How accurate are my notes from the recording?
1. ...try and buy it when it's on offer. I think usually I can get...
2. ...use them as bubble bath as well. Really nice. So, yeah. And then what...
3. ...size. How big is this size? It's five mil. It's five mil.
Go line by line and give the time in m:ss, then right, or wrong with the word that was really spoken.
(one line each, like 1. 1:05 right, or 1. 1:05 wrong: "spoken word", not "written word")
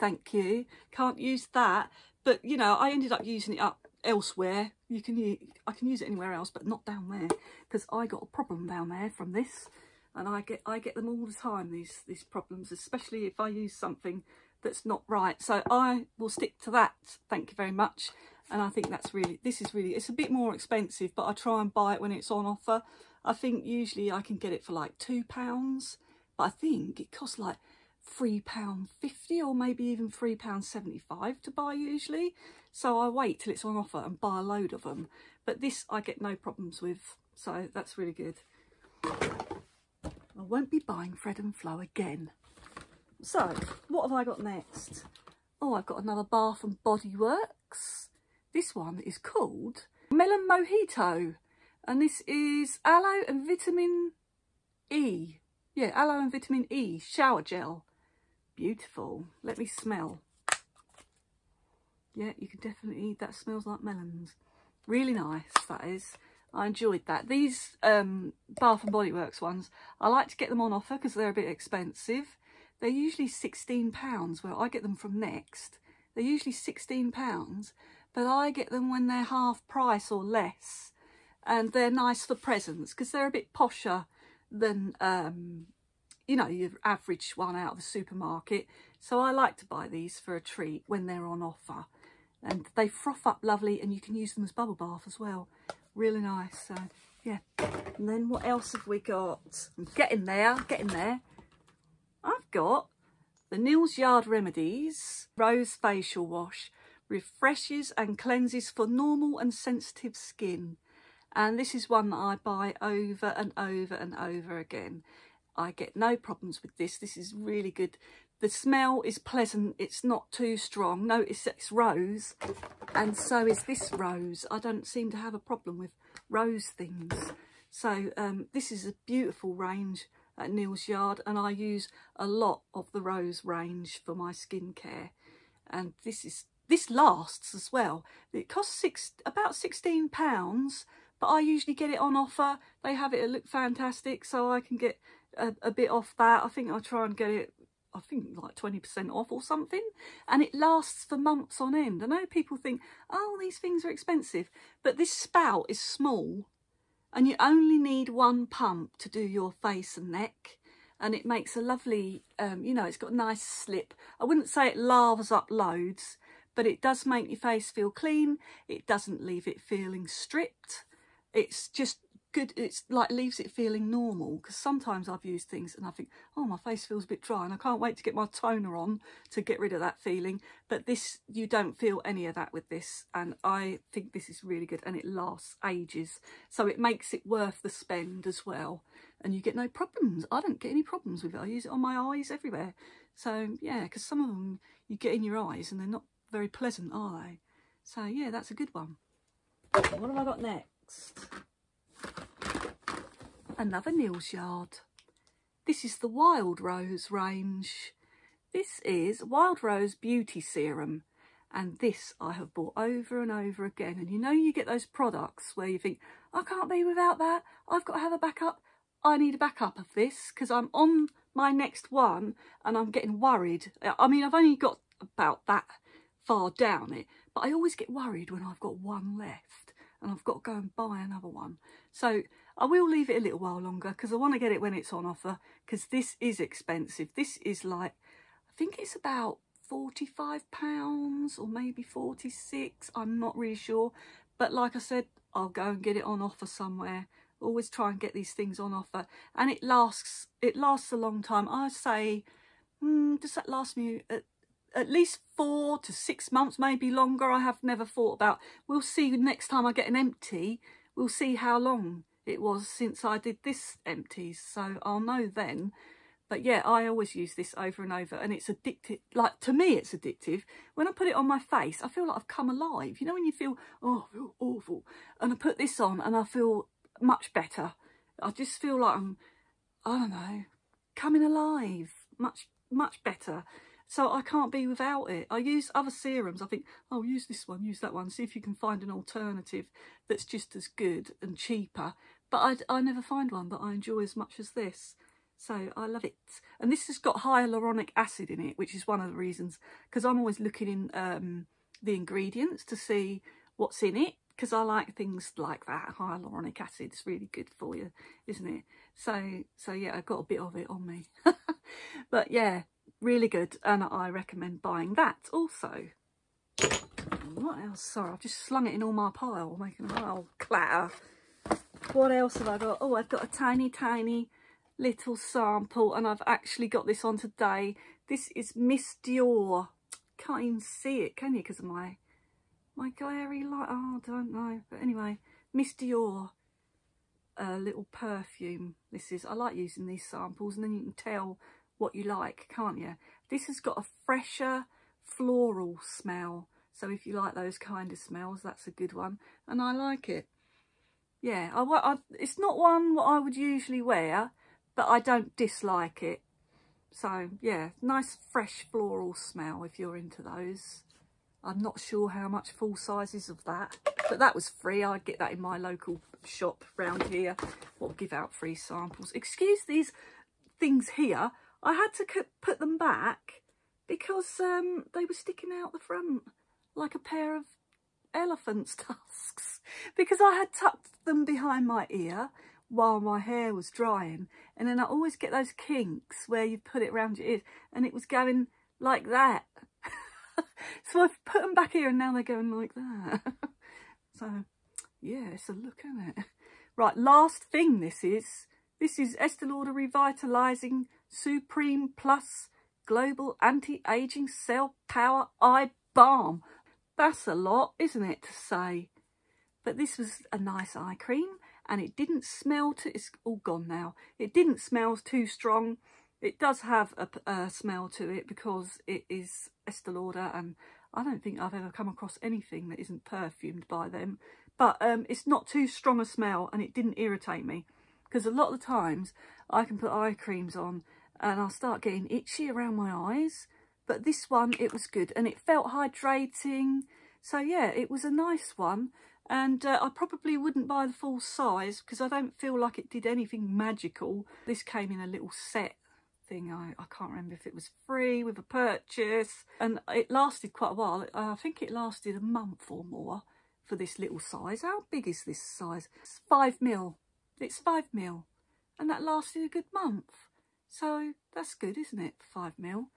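1. 0:21 right
2. 1:34 right
3. 7:34 right.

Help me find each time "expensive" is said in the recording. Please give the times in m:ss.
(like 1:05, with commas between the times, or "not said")
0:20, 1:11, 2:33, 3:56.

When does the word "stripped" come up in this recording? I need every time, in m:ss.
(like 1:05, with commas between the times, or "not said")
2:50.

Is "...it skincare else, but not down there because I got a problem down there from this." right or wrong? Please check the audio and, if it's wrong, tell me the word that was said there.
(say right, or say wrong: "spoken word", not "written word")
wrong: "anywhere", not "skincare".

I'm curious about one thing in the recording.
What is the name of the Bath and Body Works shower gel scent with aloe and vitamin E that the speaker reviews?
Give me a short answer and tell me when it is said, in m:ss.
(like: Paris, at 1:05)
Melon Mojito, at 0:50.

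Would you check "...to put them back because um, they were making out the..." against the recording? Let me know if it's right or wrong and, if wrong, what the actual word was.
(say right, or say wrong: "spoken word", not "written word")
wrong: "sticking", not "making".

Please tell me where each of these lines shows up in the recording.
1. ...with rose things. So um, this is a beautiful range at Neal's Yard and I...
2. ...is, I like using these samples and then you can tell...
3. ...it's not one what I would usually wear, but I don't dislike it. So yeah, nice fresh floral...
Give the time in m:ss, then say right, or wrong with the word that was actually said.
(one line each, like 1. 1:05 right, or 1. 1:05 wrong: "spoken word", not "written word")
1. 2:05 right
2. 5:39 right
3. 5:52 right.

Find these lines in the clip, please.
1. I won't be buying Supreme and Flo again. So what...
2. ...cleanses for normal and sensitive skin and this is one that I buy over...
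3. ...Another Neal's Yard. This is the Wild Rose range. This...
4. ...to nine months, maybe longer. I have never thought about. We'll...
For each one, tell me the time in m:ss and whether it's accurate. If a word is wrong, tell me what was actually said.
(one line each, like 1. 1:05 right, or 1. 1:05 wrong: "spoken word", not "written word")
1. 0:39 wrong: "Fred", not "Supreme"
2. 1:48 right
3. 3:23 right
4. 4:15 wrong: "six", not "nine".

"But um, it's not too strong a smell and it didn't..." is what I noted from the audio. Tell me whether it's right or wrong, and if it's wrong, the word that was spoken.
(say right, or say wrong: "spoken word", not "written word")
right.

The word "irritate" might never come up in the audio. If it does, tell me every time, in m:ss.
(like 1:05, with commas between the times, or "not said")
7:06.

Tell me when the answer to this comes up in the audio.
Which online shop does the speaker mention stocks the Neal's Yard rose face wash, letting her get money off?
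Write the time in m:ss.
2:23.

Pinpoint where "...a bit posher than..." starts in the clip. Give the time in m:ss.
1:23.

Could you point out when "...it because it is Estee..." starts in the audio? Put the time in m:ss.
6:58.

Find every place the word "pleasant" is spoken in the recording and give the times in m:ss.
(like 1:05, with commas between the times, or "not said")
1:59, 3:16.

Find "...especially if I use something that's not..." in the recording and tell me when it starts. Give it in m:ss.
0:12.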